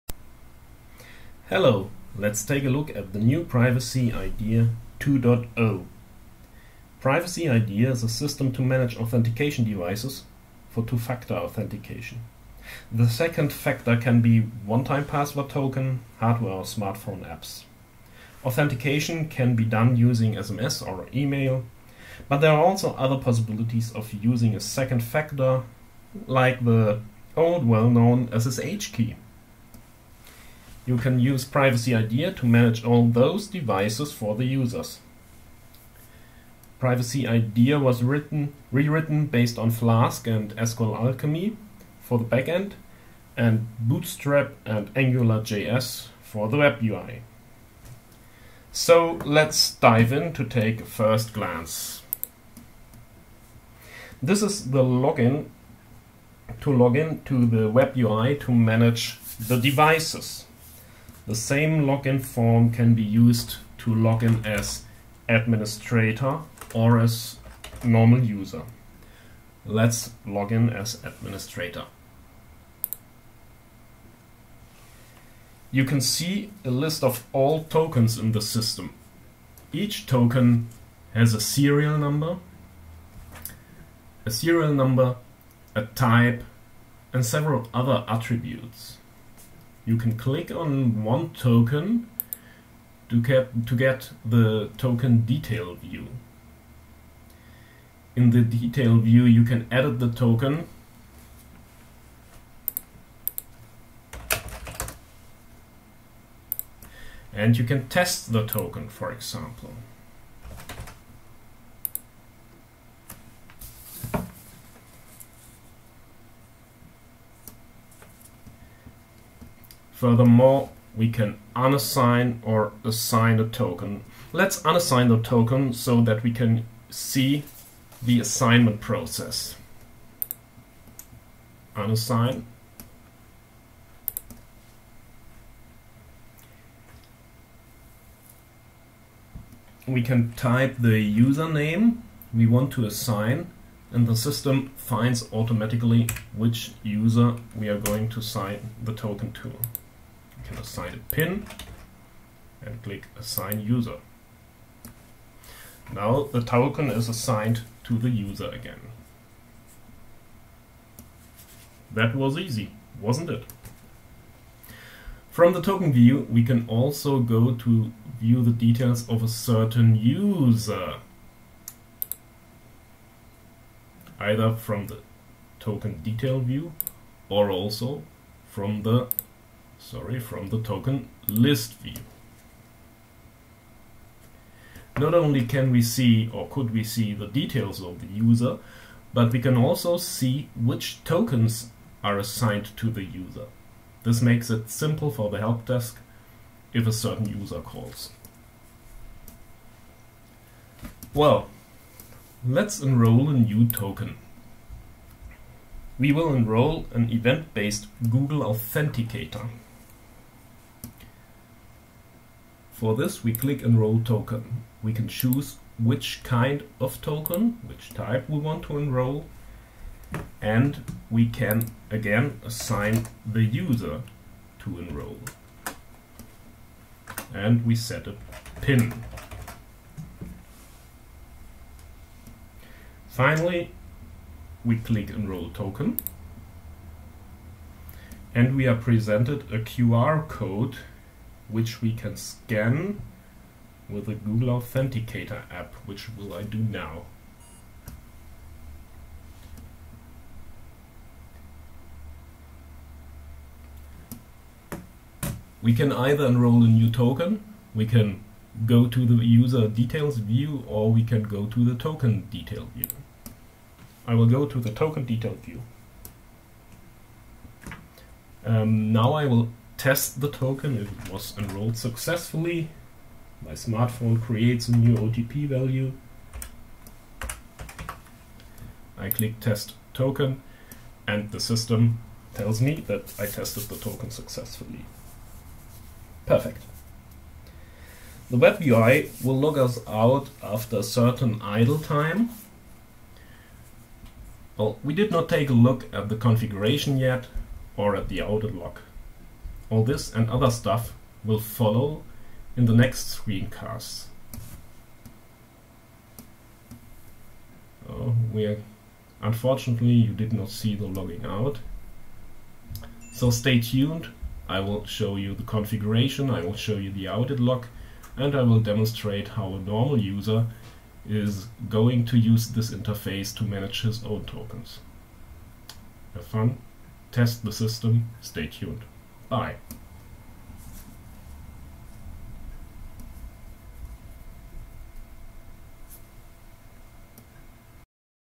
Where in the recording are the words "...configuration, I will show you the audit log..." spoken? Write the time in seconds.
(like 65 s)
315 s.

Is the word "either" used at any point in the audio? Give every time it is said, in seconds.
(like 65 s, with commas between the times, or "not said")
174 s, 255 s.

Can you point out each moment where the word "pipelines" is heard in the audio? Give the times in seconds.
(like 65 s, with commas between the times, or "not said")
not said.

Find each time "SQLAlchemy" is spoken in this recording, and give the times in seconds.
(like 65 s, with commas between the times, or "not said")
40 s.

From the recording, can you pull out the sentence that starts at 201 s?
Well, let's enroll a new token.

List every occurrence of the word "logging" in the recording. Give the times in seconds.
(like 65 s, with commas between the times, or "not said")
310 s.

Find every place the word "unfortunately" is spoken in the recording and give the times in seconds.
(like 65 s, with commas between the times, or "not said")
309 s.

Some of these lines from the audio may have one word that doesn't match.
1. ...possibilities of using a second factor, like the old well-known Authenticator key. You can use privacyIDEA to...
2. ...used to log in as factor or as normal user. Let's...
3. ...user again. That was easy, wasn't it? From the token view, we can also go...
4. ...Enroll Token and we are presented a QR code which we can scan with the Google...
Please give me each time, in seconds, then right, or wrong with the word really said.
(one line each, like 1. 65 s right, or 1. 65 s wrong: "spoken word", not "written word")
1. 23 s wrong: "SSH", not "Authenticator"
2. 63 s wrong: "administrator", not "factor"
3. 158 s right
4. 235 s right.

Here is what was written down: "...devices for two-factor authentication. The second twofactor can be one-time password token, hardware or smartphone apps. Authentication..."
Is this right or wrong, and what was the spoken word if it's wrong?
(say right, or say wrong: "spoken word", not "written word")
wrong: "factor", not "twofactor".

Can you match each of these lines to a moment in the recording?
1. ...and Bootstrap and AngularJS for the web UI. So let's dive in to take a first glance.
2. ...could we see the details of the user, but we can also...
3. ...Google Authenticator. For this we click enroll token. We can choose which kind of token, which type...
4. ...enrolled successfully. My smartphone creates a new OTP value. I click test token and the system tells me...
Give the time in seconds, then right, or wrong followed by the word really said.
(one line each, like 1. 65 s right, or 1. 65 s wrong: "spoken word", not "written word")
1. 43 s right
2. 186 s right
3. 208 s right
4. 271 s right.